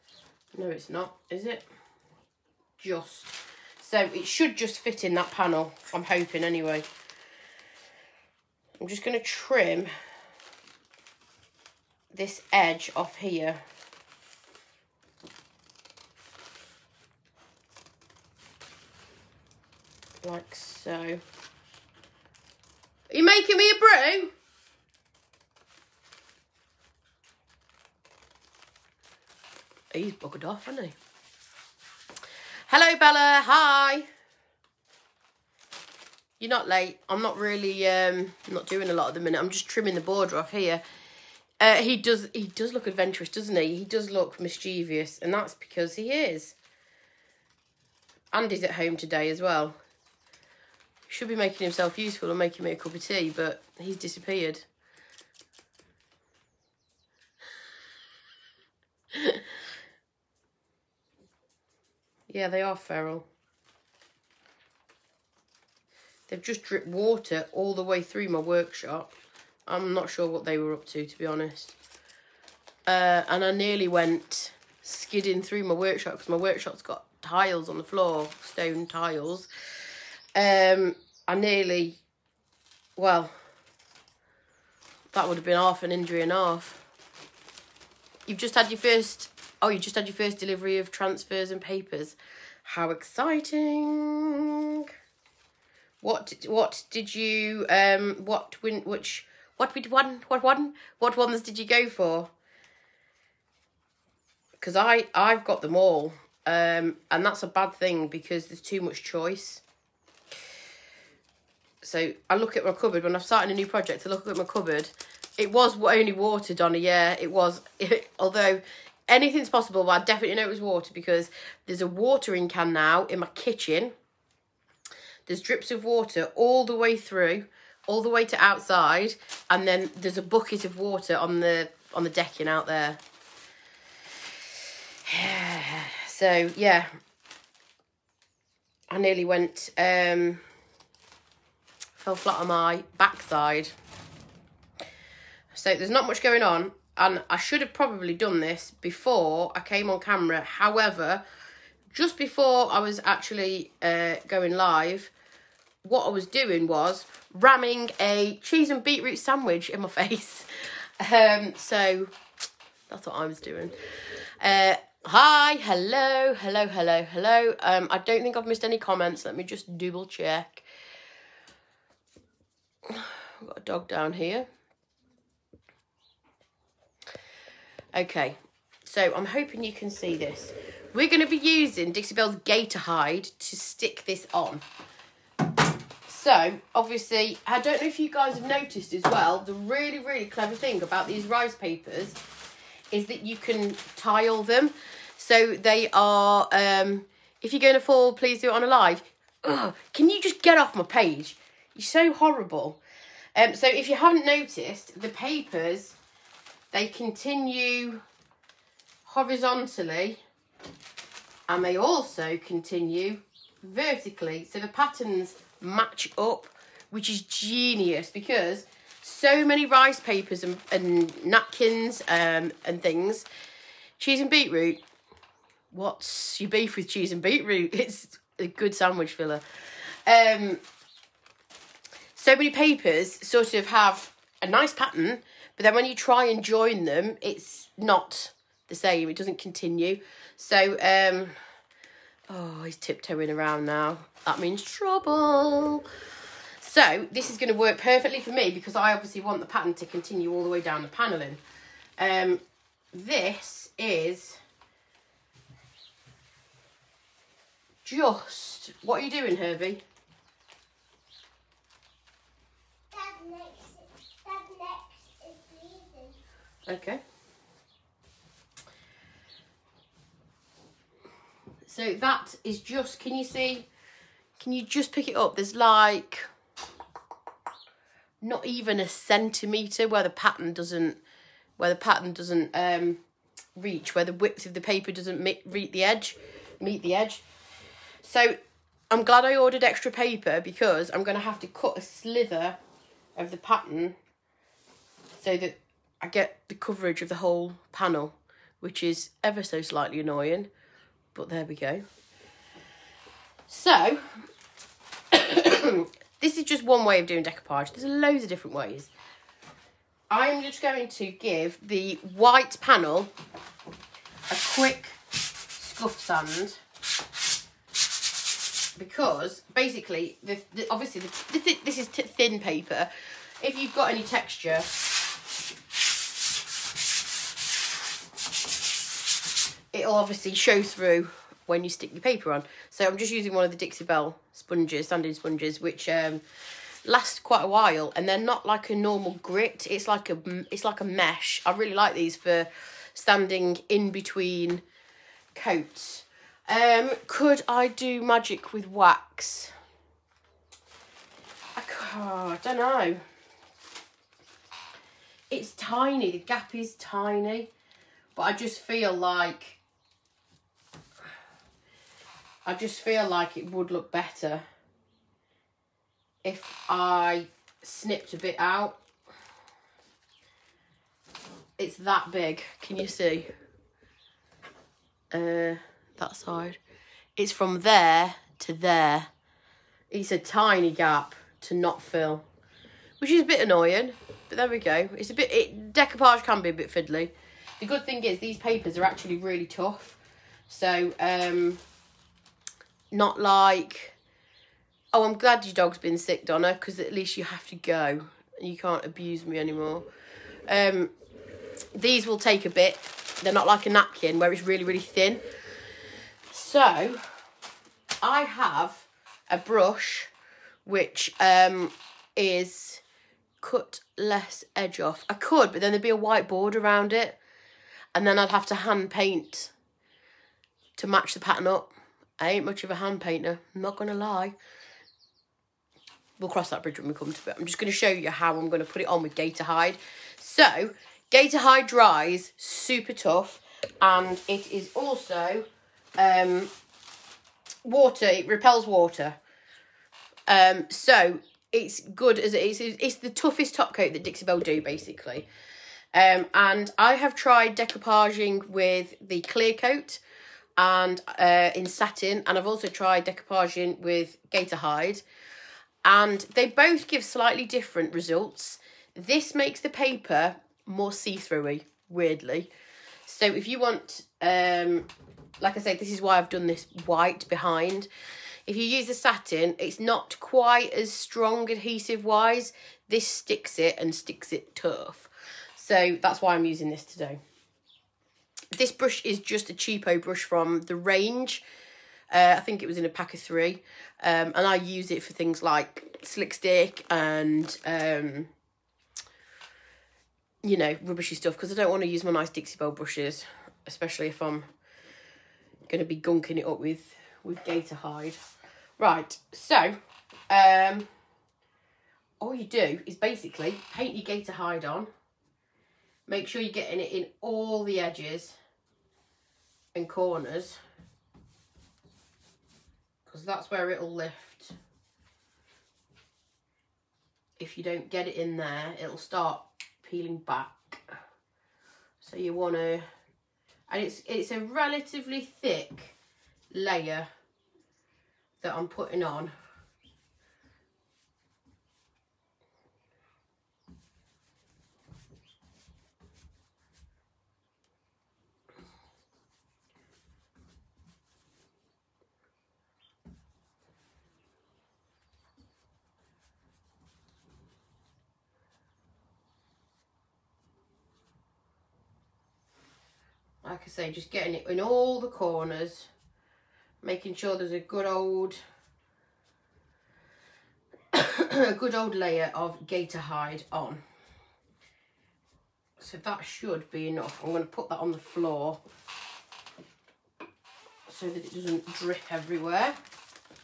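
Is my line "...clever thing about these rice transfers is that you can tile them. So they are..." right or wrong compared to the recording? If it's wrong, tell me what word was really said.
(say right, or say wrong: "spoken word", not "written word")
wrong: "papers", not "transfers".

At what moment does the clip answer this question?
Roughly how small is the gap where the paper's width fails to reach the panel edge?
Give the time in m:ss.
4:38.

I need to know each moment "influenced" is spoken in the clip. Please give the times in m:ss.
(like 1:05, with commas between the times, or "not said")
not said.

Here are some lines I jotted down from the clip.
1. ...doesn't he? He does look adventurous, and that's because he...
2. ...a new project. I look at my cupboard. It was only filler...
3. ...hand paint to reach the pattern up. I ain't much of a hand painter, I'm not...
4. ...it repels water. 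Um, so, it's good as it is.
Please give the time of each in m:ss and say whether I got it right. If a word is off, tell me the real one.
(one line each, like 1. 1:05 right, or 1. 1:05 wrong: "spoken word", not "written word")
1. 0:43 wrong: "mischievous", not "adventurous"
2. 1:53 wrong: "water", not "filler"
3. 6:58 wrong: "match", not "reach"
4. 7:18 right.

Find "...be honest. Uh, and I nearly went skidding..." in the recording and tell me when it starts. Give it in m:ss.
1:11.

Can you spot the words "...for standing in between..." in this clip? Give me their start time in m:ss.
5:42.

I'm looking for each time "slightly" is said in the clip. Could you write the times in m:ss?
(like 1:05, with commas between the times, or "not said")
4:59, 7:37.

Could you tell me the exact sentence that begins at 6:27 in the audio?
The good thing is these papers are actually really tough.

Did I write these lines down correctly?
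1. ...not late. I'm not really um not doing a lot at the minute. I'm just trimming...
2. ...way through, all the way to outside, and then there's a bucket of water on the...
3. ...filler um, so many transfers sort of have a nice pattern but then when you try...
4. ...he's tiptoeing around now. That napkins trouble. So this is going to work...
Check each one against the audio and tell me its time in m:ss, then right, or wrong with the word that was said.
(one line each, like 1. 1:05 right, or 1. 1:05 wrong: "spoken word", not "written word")
1. 0:36 right
2. 2:06 right
3. 3:49 wrong: "papers", not "transfers"
4. 4:02 wrong: "means", not "napkins".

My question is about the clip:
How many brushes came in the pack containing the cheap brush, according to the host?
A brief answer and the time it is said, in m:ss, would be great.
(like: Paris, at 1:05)
3, at 8:03.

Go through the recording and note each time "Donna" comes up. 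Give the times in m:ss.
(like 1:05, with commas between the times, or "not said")
1:56, 6:36.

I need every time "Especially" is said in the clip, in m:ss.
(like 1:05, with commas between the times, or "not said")
8:13.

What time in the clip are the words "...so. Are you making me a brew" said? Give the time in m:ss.
0:20.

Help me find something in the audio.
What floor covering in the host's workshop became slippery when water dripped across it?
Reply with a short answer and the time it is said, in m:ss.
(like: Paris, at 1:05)
Stone tiles, at 1:18.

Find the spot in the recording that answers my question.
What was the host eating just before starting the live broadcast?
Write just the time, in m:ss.
2:38.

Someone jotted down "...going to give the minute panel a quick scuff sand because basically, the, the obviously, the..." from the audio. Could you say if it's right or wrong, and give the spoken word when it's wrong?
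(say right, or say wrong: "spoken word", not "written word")
wrong: "white", not "minute".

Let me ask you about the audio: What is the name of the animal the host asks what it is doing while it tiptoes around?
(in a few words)
Herbie.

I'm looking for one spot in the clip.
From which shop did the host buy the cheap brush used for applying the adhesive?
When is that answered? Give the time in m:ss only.
8:00.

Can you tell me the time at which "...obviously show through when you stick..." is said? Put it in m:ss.
5:29.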